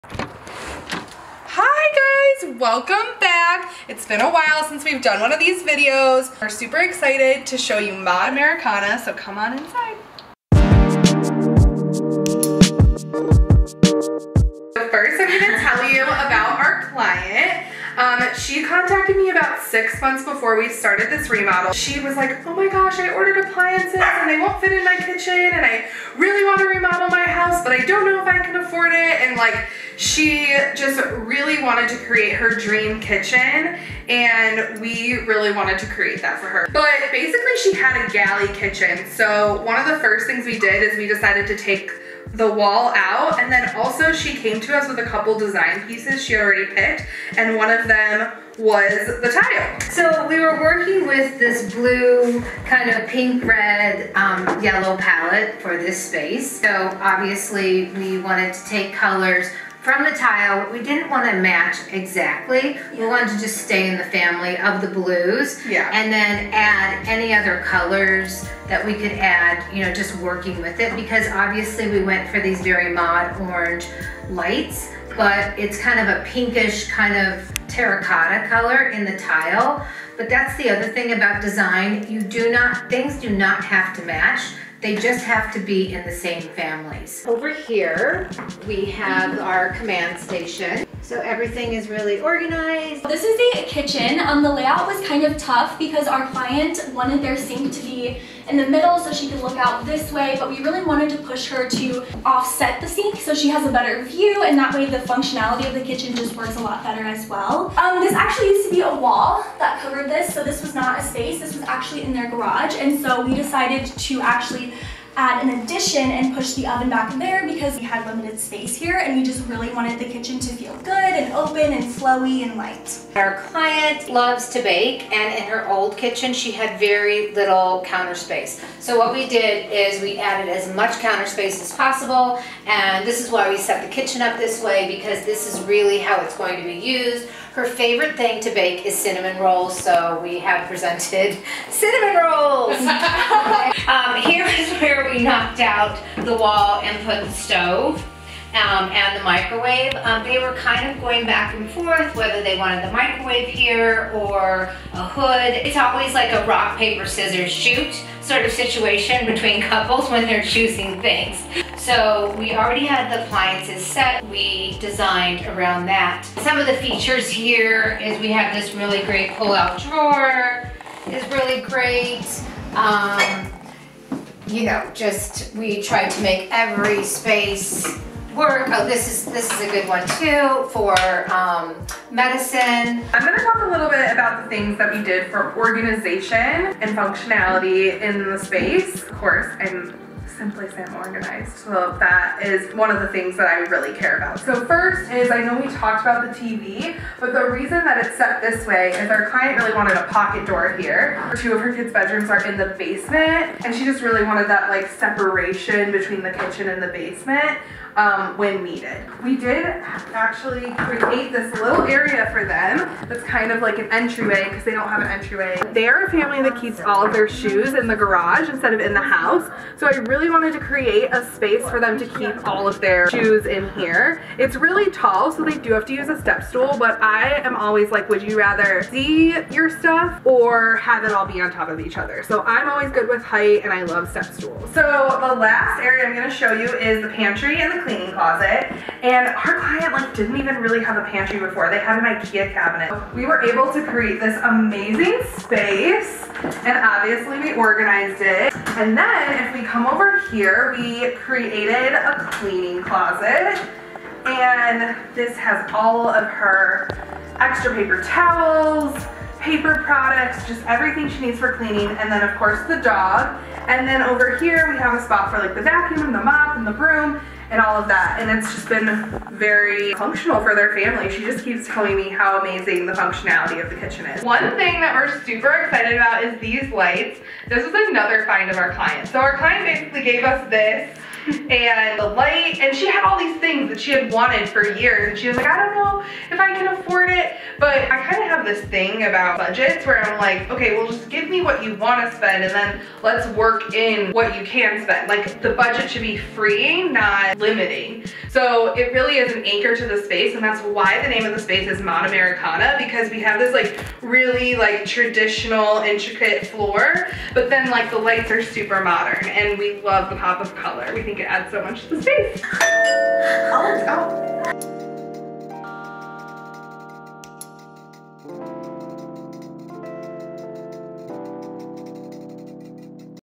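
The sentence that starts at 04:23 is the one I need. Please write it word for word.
And then over here we have a spot for like the vacuum and the mop and the broom, and all of that.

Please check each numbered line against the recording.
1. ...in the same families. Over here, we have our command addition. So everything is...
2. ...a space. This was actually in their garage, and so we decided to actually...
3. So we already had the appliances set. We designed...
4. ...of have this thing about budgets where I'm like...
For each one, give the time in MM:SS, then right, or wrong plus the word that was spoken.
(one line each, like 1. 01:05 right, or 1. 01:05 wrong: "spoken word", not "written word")
1. 01:25 wrong: "station", not "addition"
2. 01:50 right
3. 02:41 right
4. 04:48 right.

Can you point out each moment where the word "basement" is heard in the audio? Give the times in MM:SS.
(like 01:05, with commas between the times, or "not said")
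03:22, 03:26.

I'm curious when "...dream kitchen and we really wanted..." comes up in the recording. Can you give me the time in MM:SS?
00:32.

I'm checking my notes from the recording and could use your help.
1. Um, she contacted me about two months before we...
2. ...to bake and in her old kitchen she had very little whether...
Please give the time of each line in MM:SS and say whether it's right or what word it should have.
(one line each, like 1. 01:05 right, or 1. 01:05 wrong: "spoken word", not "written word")
1. 00:17 wrong: "six", not "two"
2. 02:04 wrong: "counter", not "whether".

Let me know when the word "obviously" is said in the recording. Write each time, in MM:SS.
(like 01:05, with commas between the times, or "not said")
00:57, 01:11, 04:06.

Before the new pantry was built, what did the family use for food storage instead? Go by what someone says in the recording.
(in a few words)
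An Ikea cabinet.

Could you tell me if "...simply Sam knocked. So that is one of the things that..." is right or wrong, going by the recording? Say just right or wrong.
wrong.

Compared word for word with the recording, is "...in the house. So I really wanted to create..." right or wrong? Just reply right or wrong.
right.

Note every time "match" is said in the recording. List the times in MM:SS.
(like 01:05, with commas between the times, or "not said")
01:01, 01:24.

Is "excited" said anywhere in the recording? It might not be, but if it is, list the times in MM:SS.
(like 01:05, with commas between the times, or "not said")
00:06, 04:35.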